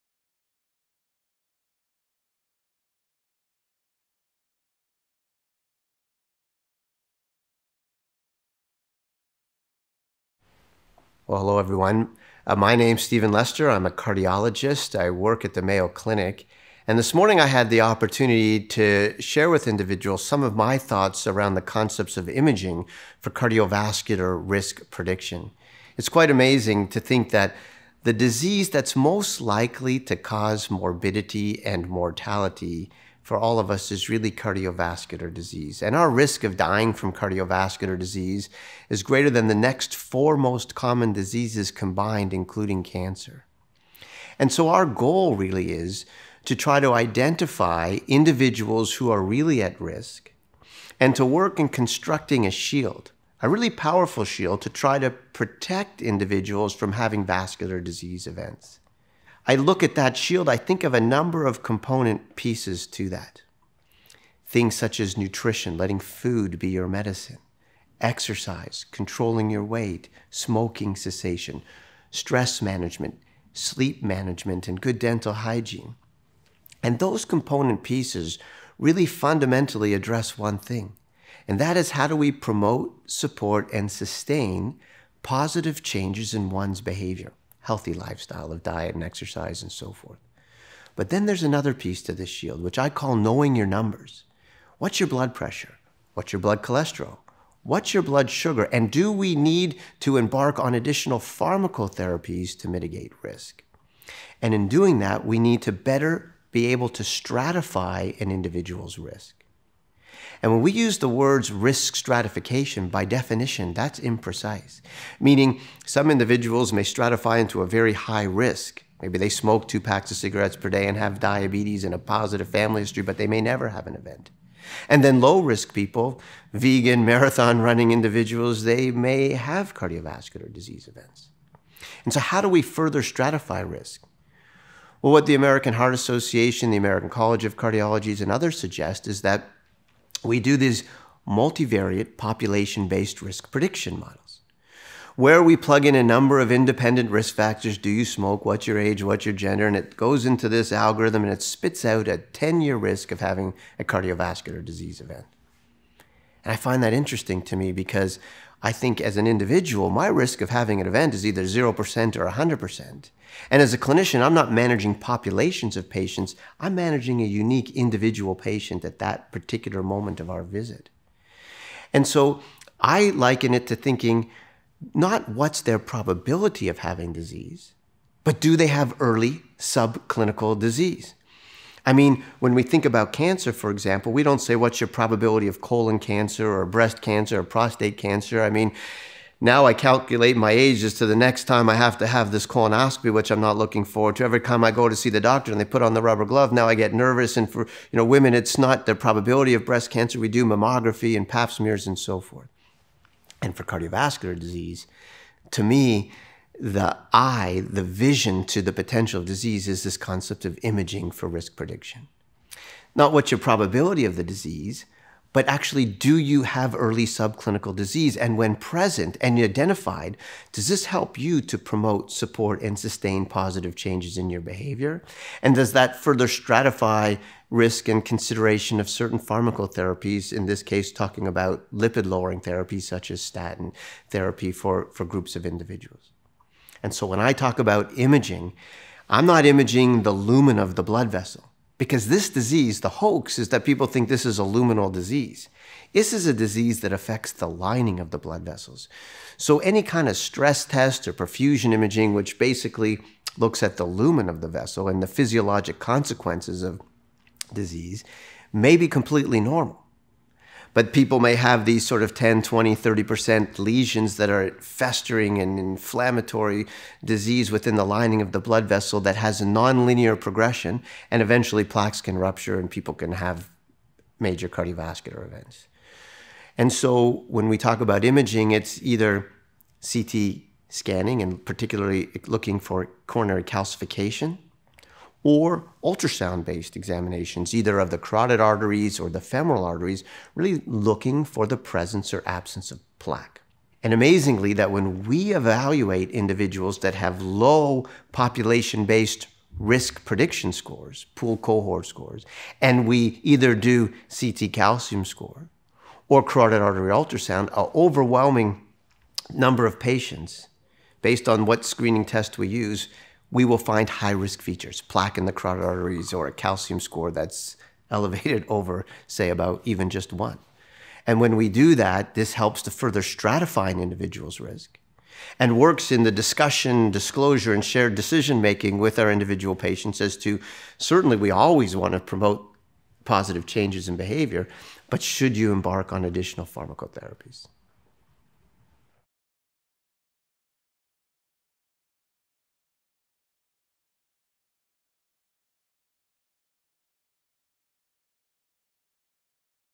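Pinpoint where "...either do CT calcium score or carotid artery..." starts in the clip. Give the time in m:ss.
5:03.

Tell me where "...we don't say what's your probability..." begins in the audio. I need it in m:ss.
3:04.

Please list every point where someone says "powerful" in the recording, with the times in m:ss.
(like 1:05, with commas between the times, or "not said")
0:53.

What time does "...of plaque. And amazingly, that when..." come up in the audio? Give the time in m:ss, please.
4:52.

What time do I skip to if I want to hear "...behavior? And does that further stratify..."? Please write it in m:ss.
3:44.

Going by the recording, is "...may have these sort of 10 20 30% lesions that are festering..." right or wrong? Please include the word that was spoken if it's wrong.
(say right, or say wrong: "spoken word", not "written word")
right.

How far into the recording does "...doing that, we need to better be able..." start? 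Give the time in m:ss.
1:44.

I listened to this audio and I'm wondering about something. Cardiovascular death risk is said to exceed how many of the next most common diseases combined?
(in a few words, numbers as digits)
4.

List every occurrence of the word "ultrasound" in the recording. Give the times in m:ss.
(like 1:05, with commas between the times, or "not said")
4:45, 5:06.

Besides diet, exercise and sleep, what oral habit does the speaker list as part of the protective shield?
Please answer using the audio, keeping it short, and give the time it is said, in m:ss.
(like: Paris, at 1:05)
good dental hygiene, at 1:14.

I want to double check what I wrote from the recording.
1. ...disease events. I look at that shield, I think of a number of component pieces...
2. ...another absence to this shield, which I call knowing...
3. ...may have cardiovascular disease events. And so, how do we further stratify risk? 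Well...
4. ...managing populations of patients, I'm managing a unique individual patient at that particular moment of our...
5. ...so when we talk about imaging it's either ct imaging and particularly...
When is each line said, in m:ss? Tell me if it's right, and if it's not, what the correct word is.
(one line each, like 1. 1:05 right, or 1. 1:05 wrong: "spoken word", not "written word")
1. 0:57 right
2. 1:31 wrong: "piece", not "absence"
3. 2:08 right
4. 2:44 right
5. 4:36 wrong: "scanning", not "imaging".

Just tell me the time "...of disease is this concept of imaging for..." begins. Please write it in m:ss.
3:29.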